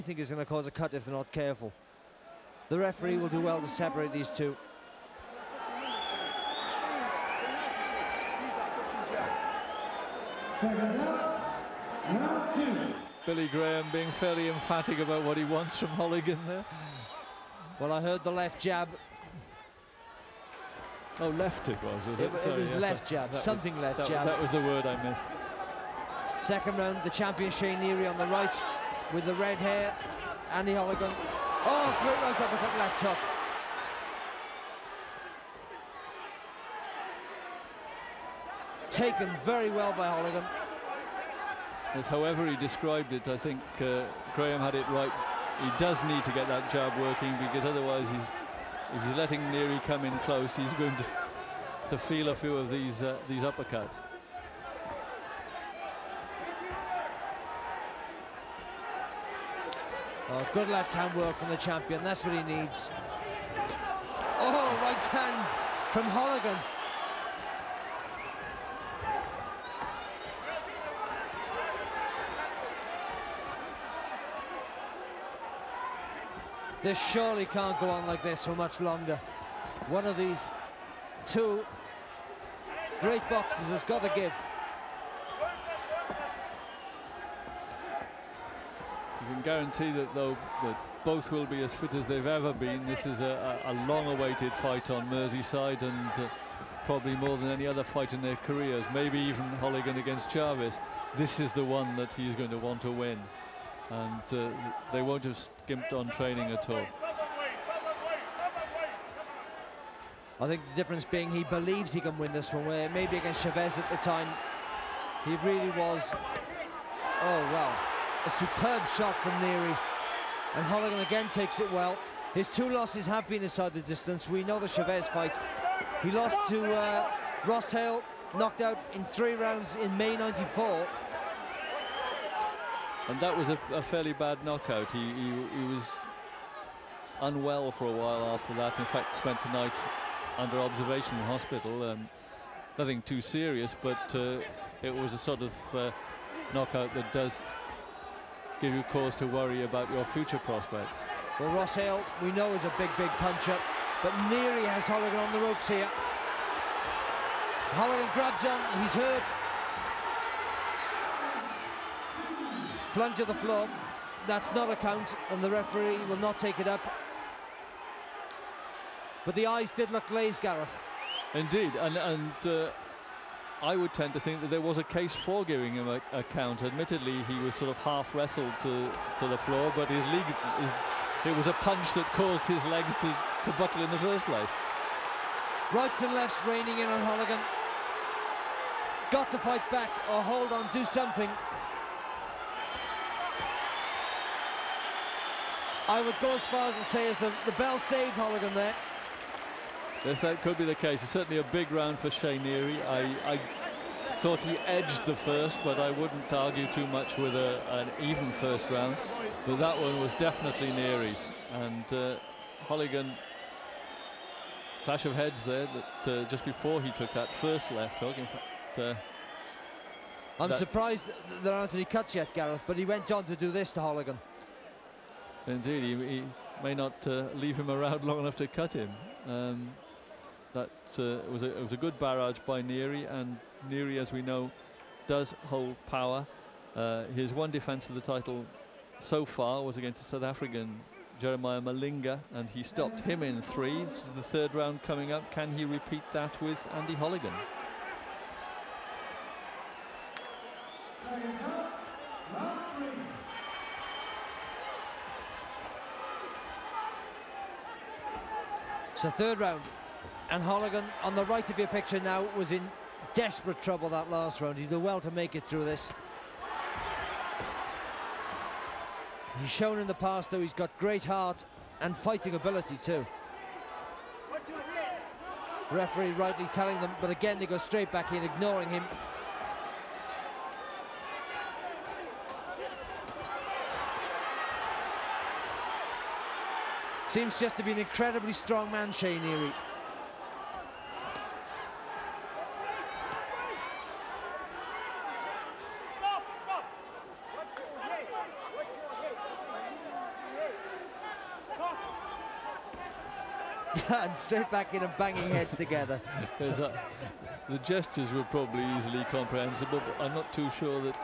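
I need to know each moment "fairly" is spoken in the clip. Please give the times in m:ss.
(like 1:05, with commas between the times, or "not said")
0:14, 2:13.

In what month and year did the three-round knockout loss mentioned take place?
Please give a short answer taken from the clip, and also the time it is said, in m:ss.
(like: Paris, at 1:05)
May 1994, at 2:09.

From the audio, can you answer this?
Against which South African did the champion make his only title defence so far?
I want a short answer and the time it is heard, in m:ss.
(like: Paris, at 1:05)
Jeremiah Malinga, at 4:01.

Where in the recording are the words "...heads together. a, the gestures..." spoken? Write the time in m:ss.
5:05.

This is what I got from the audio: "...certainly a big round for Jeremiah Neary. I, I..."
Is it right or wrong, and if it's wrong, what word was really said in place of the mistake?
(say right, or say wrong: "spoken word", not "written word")
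wrong: "Shea", not "Jeremiah".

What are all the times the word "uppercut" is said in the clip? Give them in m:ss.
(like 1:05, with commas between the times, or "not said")
0:32, 0:53.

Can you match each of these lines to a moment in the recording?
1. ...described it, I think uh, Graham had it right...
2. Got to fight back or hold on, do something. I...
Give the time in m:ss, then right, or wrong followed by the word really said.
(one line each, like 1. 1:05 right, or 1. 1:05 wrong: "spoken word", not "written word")
1. 0:42 right
2. 3:09 right.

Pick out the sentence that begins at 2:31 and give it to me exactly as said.
Well, Ross Hale, we know is a big, big puncher, but Neary has Holligan on the ropes here.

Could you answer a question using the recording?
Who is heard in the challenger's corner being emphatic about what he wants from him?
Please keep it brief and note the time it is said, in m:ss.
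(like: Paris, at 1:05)
Billy Graham, at 0:13.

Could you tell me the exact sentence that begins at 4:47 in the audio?
Seems just to be an incredibly strong man, Shea Neary.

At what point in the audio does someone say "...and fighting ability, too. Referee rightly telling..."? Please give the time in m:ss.
4:31.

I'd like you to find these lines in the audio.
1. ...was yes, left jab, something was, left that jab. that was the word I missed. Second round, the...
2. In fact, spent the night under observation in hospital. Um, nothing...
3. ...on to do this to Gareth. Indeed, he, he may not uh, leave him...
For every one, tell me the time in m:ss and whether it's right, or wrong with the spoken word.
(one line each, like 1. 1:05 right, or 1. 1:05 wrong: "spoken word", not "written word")
1. 0:22 right
2. 2:18 right
3. 3:43 wrong: "Holligan", not "Gareth".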